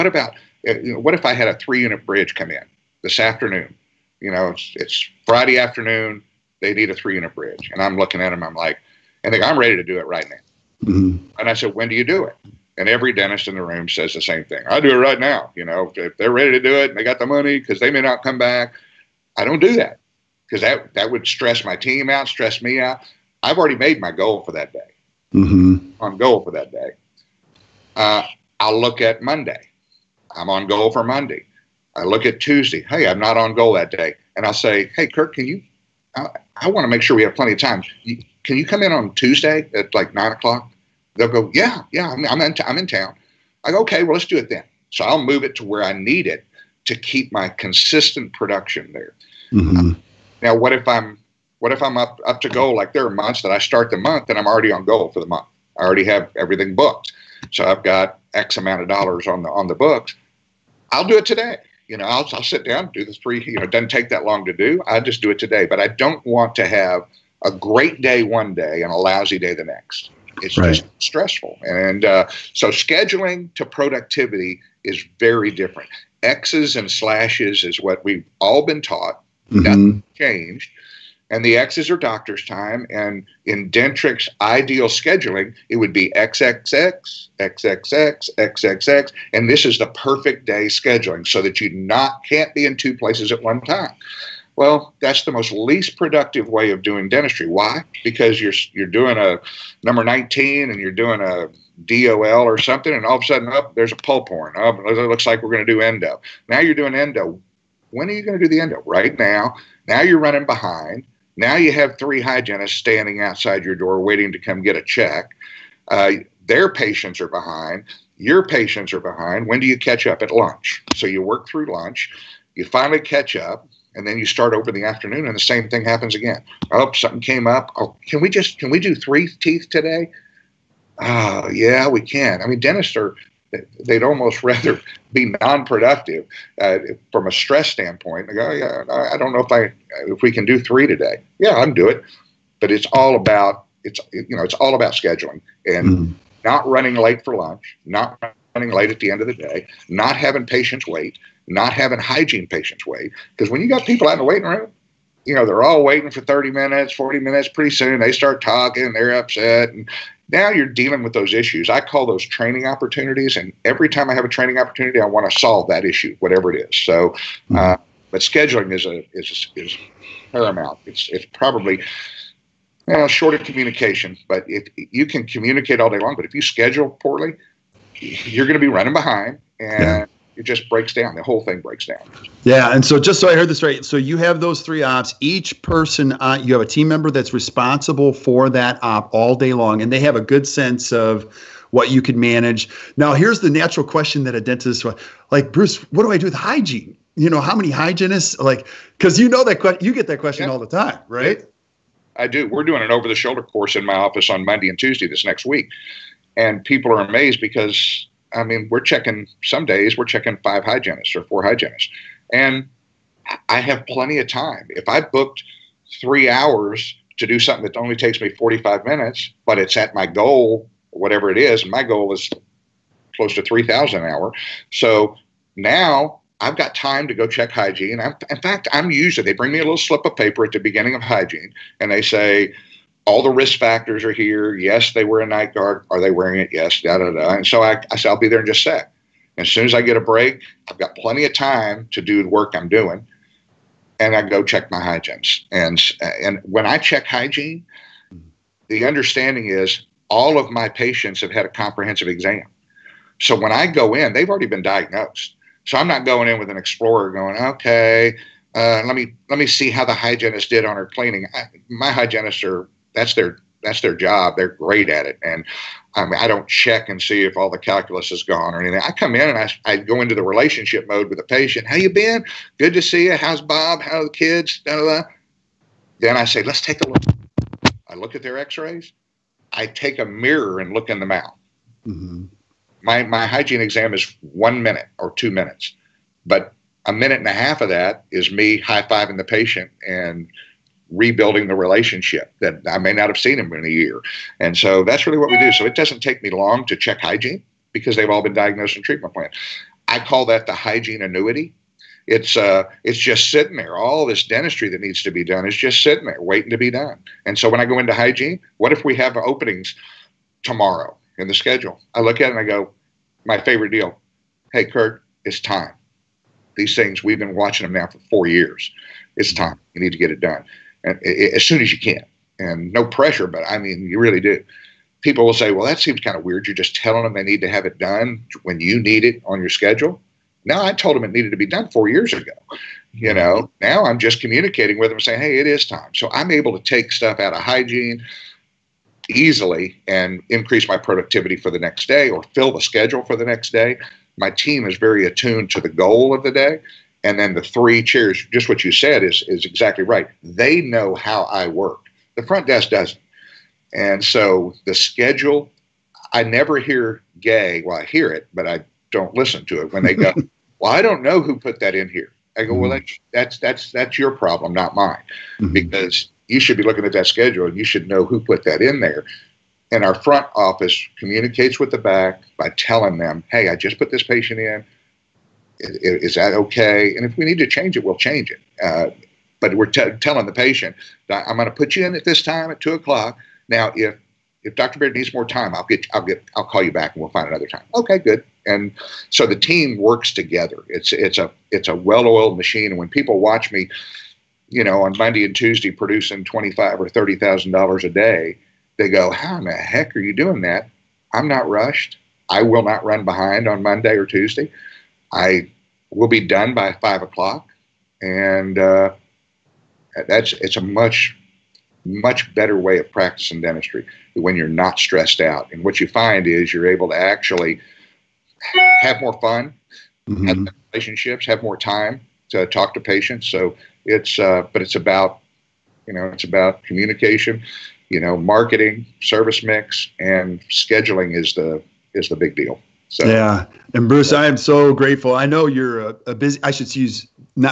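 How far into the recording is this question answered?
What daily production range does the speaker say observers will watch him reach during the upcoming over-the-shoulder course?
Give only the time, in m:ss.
6:36.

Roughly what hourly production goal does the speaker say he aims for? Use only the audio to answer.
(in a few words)
3,000 an hour.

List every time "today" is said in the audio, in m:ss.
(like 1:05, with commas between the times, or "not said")
1:01, 1:05, 2:09, 2:20.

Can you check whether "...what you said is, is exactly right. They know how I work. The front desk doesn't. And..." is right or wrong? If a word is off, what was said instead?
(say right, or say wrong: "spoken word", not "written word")
right.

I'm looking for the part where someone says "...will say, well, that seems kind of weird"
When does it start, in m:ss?
5:25.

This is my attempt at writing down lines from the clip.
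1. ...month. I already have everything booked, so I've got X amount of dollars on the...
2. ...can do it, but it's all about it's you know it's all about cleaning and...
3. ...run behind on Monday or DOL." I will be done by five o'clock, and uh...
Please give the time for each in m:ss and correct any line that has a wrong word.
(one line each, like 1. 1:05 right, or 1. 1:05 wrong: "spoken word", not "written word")
1. 0:55 right
2. 2:21 wrong: "scheduling", not "cleaning"
3. 6:42 wrong: "Tuesday", not "DOL".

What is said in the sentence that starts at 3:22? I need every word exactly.
We're doing an over the shoulder course in my office on Monday and Tuesday this next week.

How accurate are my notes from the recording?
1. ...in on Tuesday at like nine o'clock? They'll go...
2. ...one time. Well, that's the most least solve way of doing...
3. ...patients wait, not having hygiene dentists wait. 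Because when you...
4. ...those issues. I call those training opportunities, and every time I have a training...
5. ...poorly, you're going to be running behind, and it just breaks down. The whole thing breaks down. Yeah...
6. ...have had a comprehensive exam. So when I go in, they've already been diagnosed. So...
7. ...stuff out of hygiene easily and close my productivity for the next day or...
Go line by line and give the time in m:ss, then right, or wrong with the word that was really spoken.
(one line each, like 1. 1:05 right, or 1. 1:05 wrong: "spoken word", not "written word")
1. 0:38 right
2. 1:33 wrong: "productive", not "solve"
3. 2:30 wrong: "patients", not "dentists"
4. 2:41 right
5. 2:56 right
6. 4:11 right
7. 5:36 wrong: "increase", not "close".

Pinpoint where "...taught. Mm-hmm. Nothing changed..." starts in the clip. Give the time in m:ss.
1:18.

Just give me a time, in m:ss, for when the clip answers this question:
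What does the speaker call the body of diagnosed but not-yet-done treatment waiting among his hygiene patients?
5:00.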